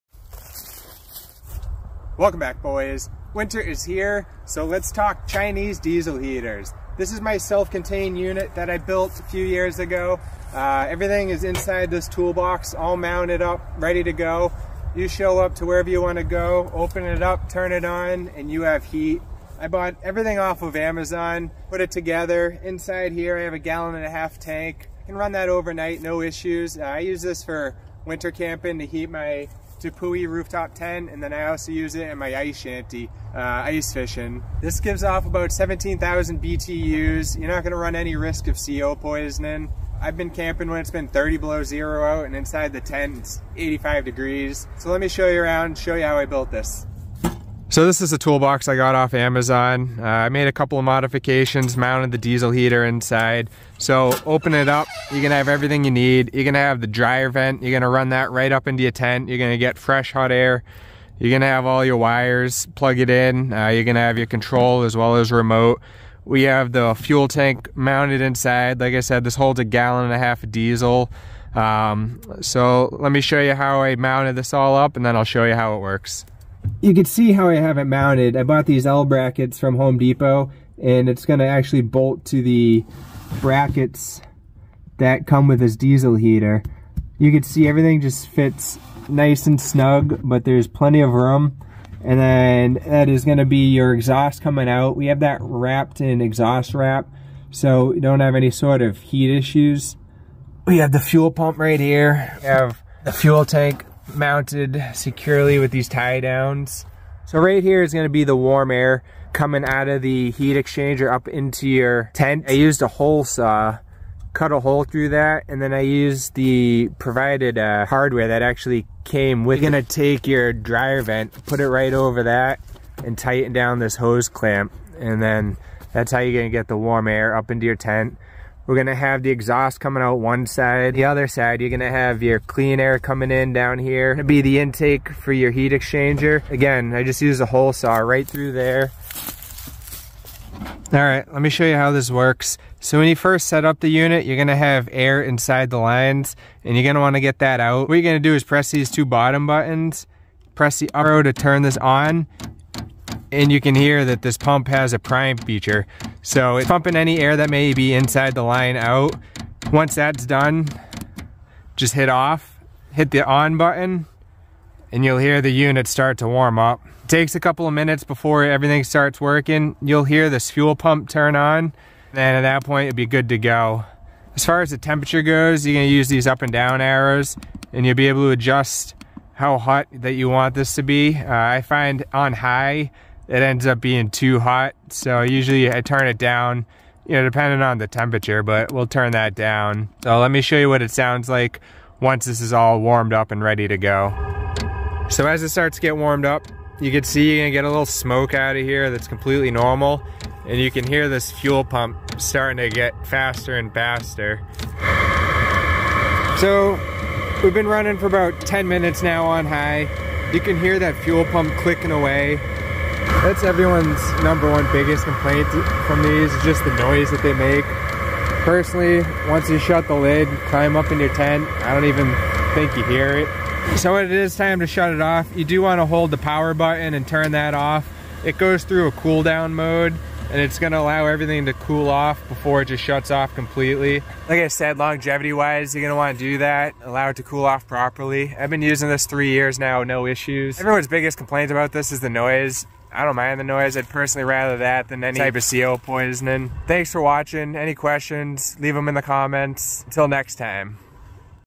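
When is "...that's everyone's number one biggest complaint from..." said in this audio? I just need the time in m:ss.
3:33.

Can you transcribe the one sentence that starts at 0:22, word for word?
Inside here I have a gallon and a half tank.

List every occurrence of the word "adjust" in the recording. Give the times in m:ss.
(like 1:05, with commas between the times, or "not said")
2:58.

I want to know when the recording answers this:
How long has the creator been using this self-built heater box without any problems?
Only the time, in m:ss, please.
3:59.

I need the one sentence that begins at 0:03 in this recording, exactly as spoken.
Winter is here, so let's talk Chinese diesel heaters.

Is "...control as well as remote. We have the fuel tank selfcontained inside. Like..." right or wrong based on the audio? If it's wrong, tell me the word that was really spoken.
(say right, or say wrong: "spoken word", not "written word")
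wrong: "mounted", not "selfcontained".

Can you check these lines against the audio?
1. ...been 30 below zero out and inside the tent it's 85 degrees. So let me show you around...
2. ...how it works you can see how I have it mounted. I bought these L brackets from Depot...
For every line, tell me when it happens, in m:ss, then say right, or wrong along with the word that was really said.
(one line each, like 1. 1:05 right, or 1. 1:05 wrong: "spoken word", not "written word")
1. 0:40 right
2. 1:15 wrong: "Home", not "Depot".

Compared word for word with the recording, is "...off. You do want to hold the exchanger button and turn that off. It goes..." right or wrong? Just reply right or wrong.
wrong.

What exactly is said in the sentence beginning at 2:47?
It takes a couple of minutes before everything starts working.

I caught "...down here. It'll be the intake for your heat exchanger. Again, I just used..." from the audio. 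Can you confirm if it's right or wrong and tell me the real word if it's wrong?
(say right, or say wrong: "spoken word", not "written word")
right.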